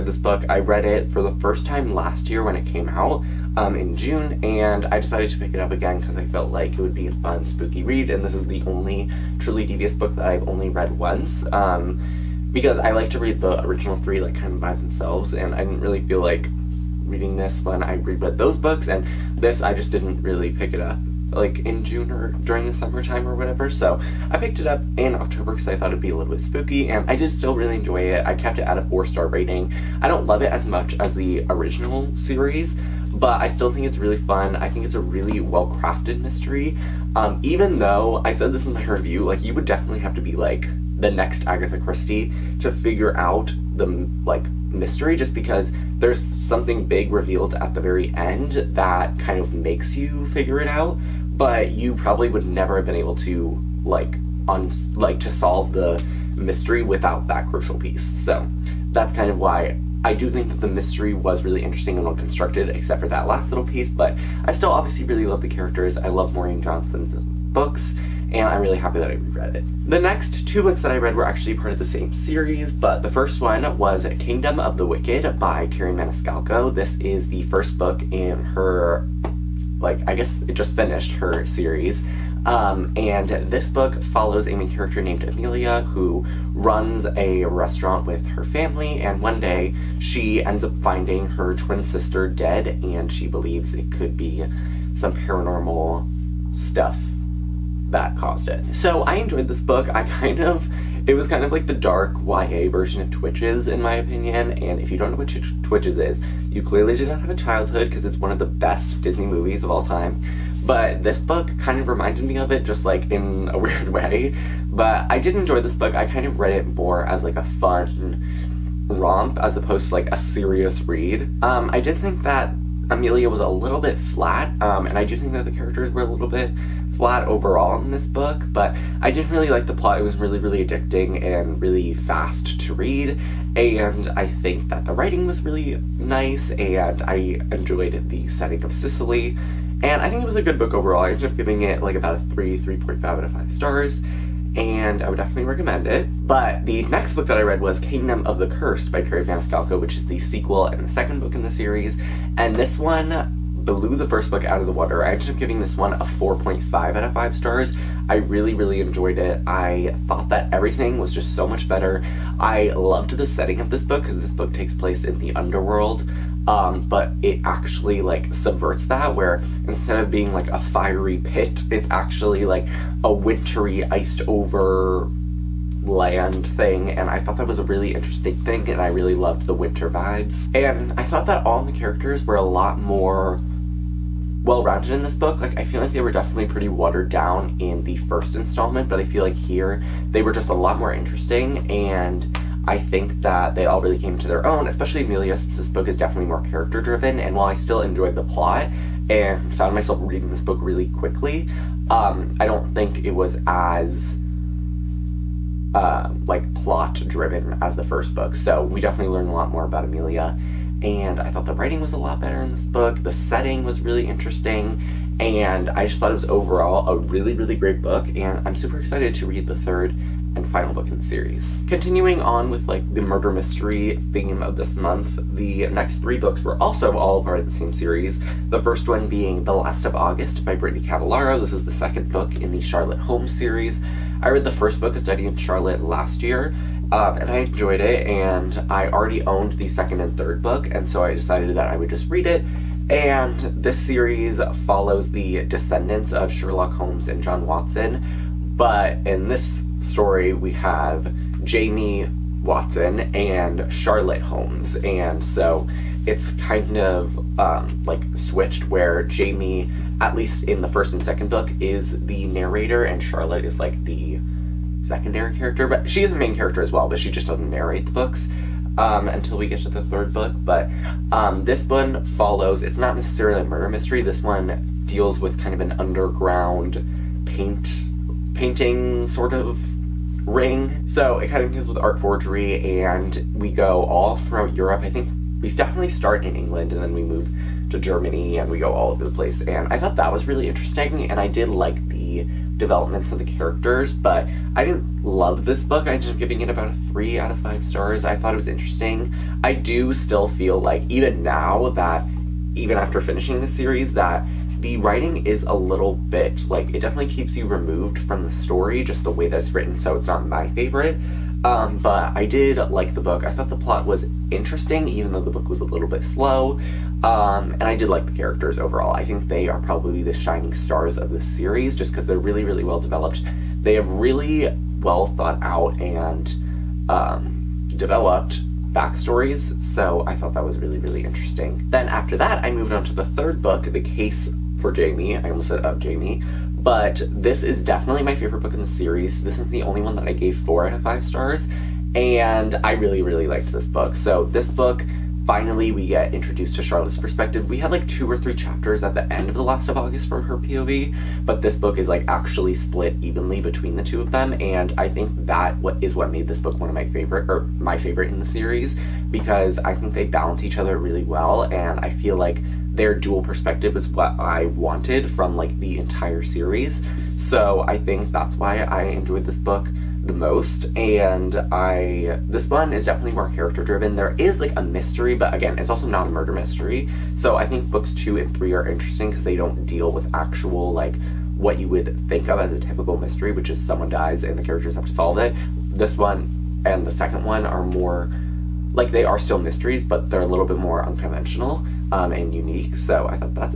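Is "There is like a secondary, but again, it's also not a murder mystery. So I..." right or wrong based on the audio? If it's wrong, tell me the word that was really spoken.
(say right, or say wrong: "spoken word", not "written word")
wrong: "mystery", not "secondary".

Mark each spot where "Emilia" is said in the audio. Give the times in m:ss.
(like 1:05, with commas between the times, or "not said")
1:25, 2:02, 3:15, 3:29.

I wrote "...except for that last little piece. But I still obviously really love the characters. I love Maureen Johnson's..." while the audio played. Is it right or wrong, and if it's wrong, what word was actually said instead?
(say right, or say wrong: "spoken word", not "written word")
right.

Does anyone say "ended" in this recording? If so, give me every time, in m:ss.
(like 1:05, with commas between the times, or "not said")
2:21, 2:35, 4:55.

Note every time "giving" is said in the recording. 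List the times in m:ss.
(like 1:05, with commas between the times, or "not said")
2:21, 2:35, 4:56.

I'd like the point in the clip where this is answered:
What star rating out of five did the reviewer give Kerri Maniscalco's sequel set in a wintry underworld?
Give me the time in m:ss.
2:35.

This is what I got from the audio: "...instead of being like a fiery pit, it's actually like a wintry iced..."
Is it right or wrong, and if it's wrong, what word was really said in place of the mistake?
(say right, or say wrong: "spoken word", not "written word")
right.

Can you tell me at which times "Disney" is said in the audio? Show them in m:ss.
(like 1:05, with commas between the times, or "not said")
1:49.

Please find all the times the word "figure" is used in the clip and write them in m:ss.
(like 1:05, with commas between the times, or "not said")
0:42, 0:50.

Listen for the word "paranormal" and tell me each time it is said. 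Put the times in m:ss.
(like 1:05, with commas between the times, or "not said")
1:35.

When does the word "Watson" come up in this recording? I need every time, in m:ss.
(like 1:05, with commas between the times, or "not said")
4:07, 4:12.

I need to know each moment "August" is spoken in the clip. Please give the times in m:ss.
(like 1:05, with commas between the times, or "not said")
3:49, 5:49.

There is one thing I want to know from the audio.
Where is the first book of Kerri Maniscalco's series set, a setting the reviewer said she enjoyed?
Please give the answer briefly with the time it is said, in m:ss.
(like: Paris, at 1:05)
Sicily, at 2:18.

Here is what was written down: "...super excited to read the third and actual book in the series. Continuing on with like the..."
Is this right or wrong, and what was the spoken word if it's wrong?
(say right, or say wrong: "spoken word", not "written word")
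wrong: "final", not "actual".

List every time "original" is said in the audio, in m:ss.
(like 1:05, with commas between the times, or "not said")
0:13, 0:31.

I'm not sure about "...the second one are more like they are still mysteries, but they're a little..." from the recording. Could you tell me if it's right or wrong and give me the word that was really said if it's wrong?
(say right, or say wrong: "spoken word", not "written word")
right.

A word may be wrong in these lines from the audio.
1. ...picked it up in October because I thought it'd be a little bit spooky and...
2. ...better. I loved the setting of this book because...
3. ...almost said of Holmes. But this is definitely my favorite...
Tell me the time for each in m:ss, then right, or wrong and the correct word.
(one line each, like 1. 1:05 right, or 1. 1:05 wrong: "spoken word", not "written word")
1. 0:24 right
2. 2:41 right
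3. 5:35 wrong: "Jamie", not "Holmes".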